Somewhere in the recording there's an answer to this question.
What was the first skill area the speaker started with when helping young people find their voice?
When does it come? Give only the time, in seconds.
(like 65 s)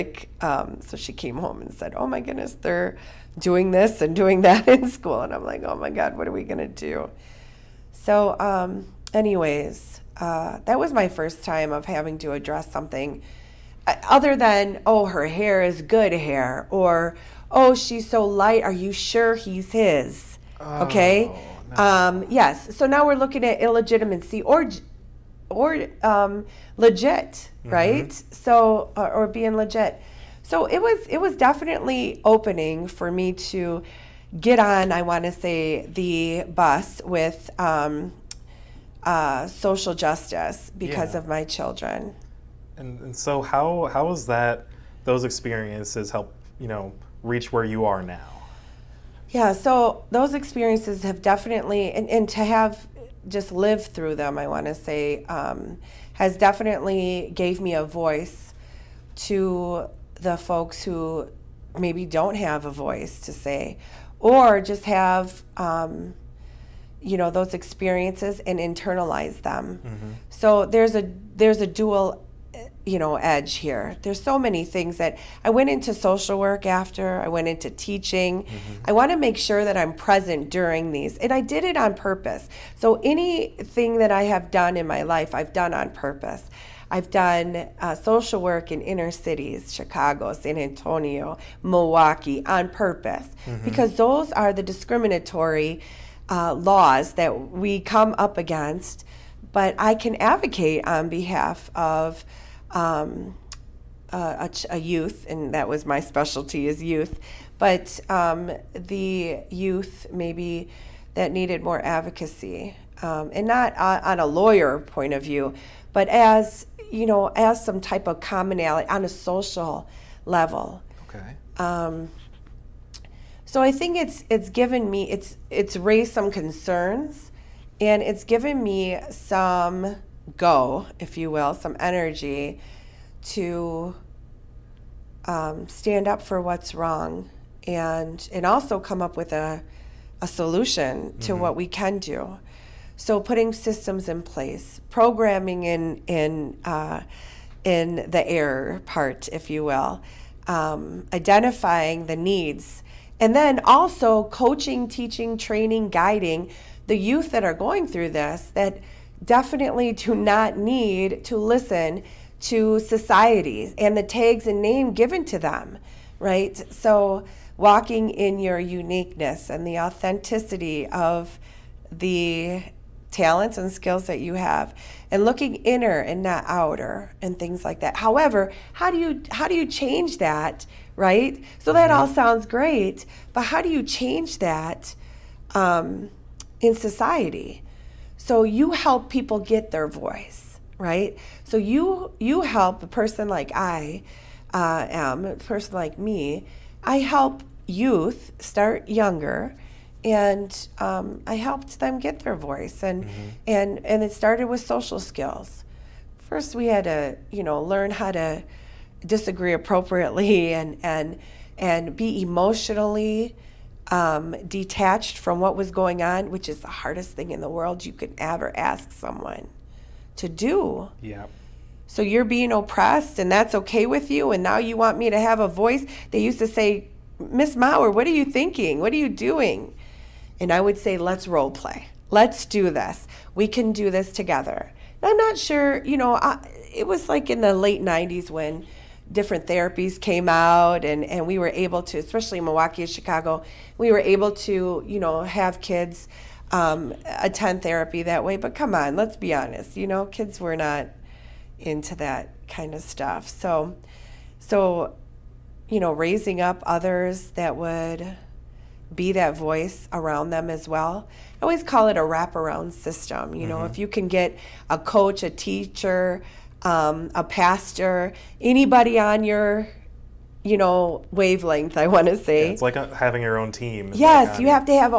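204 s.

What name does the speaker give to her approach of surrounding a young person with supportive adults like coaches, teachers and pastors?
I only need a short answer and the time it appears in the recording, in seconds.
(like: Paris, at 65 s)
Wraparound system, at 262 s.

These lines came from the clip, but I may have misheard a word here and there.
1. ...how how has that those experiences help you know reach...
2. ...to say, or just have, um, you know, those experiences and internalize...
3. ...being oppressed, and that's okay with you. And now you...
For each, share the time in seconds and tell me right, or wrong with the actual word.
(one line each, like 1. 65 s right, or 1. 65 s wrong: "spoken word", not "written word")
1. 43 s right
2. 63 s right
3. 222 s right.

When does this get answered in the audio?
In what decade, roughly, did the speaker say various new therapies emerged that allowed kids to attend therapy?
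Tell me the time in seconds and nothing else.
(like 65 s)
237 s.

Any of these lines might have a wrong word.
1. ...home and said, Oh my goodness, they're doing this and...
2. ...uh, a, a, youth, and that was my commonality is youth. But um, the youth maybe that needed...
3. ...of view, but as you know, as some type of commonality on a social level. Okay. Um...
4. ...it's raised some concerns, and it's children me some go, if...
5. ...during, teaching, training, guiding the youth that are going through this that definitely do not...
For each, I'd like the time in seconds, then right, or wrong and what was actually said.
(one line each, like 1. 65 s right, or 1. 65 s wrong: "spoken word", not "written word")
1. 1 s right
2. 104 s wrong: "specialty", not "commonality"
3. 115 s right
4. 125 s wrong: "given", not "children"
5. 154 s wrong: "coaching", not "during".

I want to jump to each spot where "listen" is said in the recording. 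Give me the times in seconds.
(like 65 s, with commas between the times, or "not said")
161 s.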